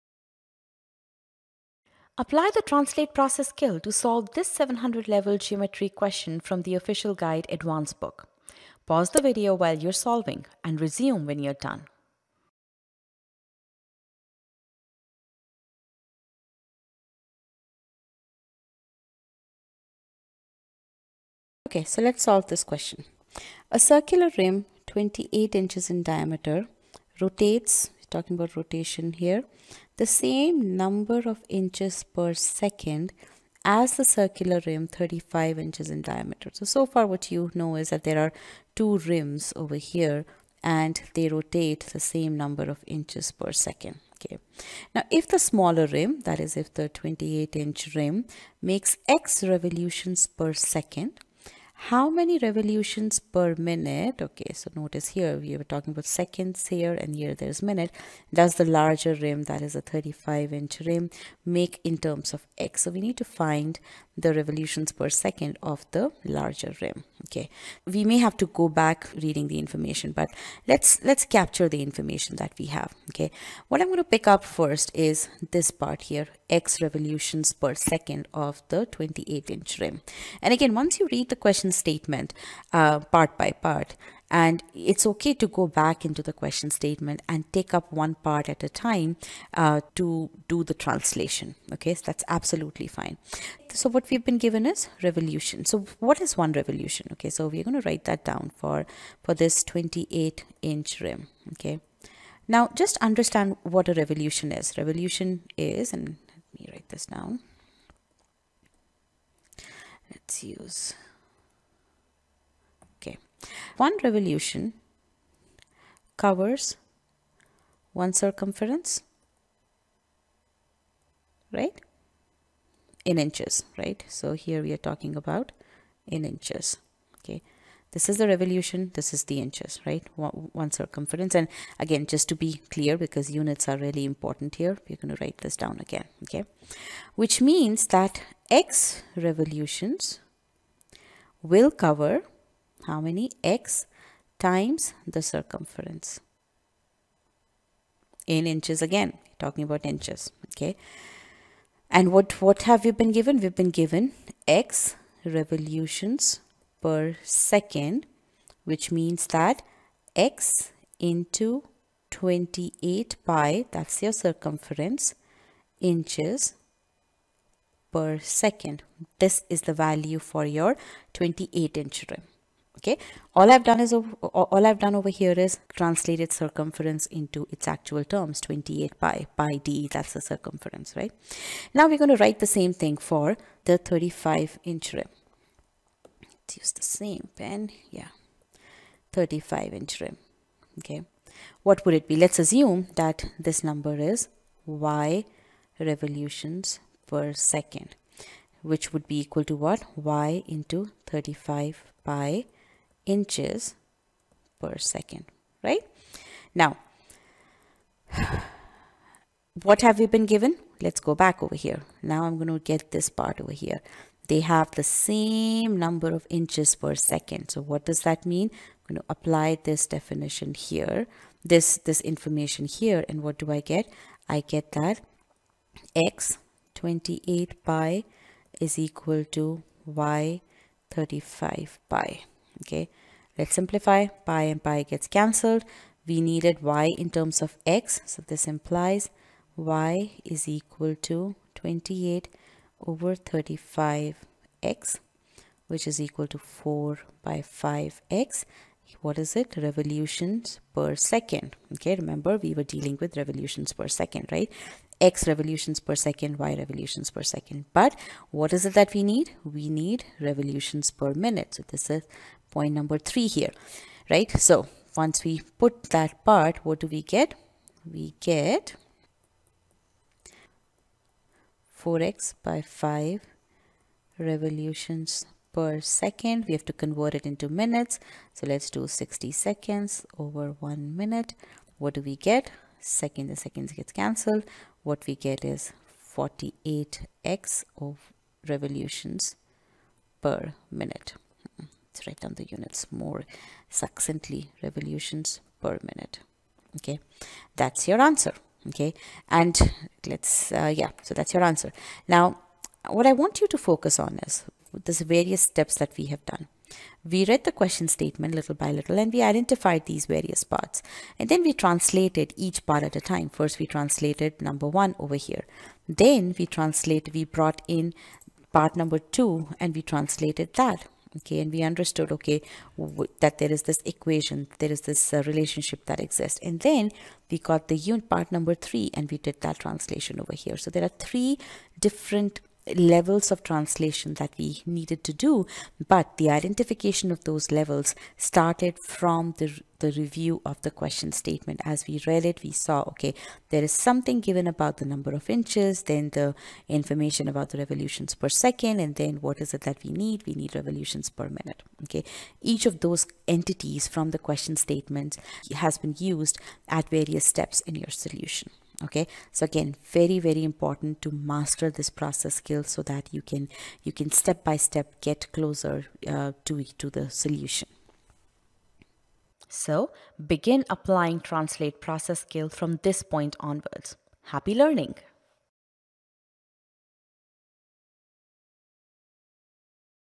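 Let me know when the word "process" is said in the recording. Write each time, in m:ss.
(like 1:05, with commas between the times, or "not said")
0:03, 6:01, 6:11.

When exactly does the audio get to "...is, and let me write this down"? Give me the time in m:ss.
1:45.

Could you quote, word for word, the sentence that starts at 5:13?
First, we translated number one over here.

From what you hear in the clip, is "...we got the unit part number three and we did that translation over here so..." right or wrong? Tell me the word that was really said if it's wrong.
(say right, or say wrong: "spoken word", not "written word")
right.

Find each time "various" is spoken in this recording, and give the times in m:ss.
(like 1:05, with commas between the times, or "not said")
5:05, 5:10, 5:56.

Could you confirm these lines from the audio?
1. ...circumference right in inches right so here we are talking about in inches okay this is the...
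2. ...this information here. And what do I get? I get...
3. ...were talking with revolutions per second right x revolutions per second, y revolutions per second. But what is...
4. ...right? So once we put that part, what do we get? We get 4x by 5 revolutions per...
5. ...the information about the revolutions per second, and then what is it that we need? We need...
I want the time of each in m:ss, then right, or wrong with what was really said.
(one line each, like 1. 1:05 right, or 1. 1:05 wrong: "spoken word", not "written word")
1. 1:58 right
2. 3:41 right
3. 4:12 wrong: "dealing", not "talking"
4. 4:24 right
5. 5:46 right.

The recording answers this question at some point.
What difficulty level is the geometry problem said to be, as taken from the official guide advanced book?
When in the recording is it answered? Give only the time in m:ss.
0:04.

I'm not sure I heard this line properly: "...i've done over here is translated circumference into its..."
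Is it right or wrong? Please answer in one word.
right.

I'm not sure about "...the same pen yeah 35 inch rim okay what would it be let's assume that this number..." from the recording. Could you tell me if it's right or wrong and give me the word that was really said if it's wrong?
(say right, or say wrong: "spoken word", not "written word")
right.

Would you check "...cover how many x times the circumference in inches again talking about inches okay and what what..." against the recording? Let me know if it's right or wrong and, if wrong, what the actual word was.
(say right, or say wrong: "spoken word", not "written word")
right.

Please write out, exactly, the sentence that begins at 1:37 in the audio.
Okay, so we're going to write that down for, for this 28 inch rim.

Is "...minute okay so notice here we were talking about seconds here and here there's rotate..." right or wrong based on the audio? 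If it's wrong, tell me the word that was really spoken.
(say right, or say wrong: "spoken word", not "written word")
wrong: "minute", not "rotate".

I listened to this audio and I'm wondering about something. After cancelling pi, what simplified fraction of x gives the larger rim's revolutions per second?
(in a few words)
4/5.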